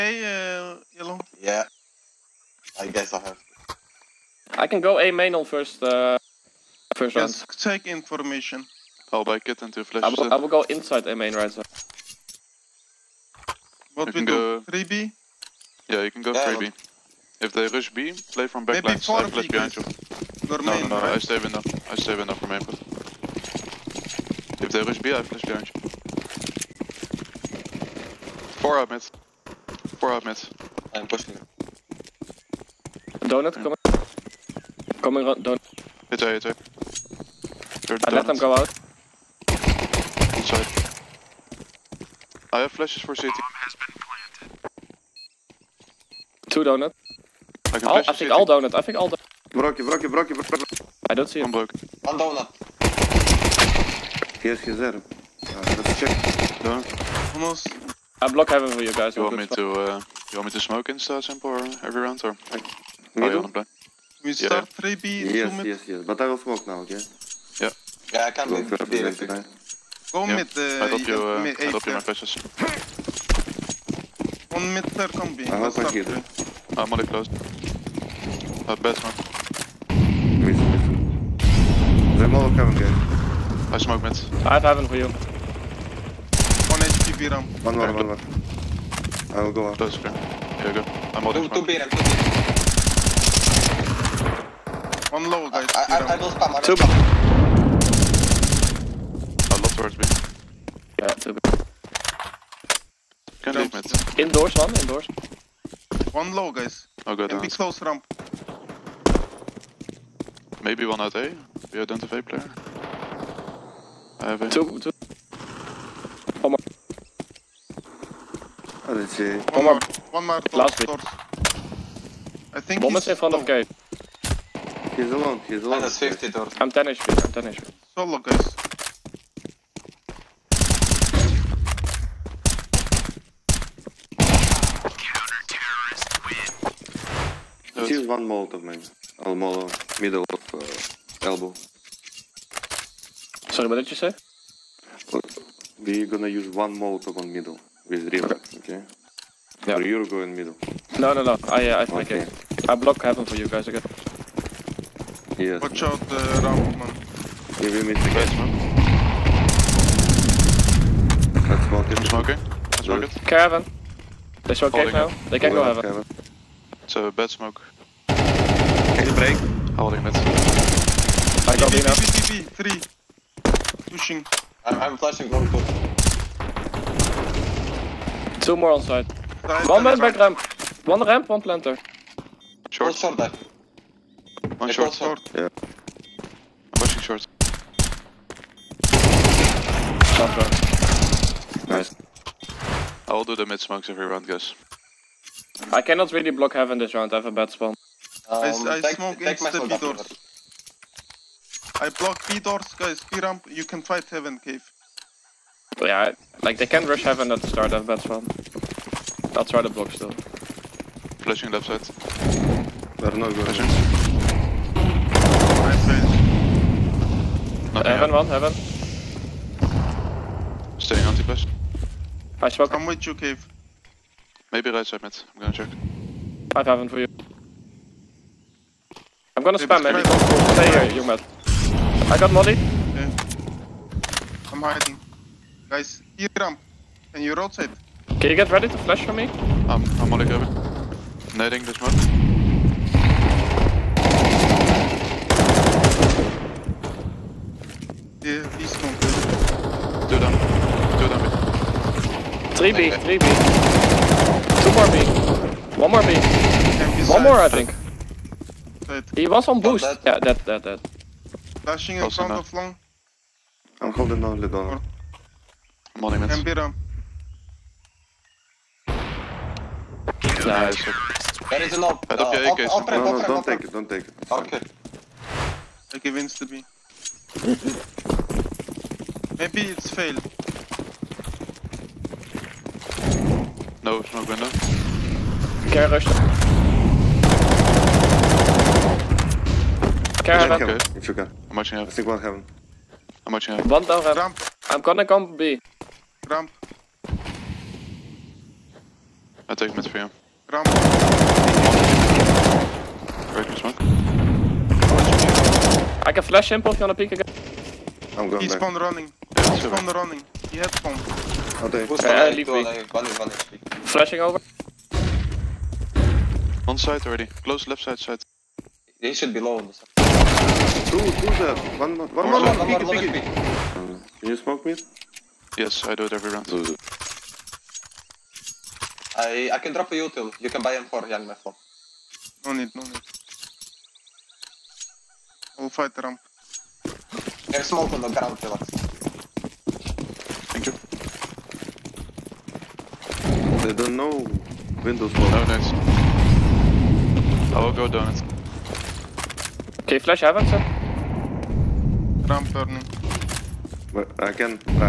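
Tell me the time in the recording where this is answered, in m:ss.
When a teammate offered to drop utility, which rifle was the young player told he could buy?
5:30.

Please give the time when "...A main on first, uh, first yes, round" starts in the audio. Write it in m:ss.
0:04.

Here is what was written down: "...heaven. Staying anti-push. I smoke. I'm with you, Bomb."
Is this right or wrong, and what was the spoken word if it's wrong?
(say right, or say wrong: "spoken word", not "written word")
wrong: "Cave", not "Bomb".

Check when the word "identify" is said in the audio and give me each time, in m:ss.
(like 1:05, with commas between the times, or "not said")
1:51.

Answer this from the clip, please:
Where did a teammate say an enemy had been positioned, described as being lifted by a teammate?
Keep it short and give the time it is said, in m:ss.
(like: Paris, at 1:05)
on boost, at 4:19.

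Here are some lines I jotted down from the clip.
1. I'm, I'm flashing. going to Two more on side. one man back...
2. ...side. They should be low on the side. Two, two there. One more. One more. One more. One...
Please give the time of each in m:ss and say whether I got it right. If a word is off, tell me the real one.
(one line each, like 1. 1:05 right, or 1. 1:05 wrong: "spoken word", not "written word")
1. 2:54 right
2. 5:17 right.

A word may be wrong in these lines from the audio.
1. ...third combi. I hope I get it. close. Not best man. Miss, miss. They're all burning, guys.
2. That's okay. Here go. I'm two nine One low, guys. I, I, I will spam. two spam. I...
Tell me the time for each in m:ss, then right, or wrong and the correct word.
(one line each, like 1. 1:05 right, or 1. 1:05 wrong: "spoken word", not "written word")
1. 1:14 wrong: "coming", not "burning"
2. 1:29 wrong: "two", not "nine".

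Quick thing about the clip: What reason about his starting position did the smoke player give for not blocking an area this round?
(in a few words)
bad spawn.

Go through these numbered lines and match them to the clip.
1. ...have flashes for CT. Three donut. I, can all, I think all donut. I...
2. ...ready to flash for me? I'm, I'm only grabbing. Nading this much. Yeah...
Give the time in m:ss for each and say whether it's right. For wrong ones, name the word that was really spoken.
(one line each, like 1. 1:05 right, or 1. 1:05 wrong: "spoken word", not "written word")
1. 0:42 wrong: "Two", not "Three"
2. 3:58 right.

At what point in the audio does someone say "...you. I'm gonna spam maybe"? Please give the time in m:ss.
3:46.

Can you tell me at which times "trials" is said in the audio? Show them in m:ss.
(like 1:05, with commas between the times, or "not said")
not said.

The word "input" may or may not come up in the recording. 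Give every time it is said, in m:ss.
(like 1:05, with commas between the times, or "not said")
0:22.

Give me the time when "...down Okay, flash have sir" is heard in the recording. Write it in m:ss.
5:47.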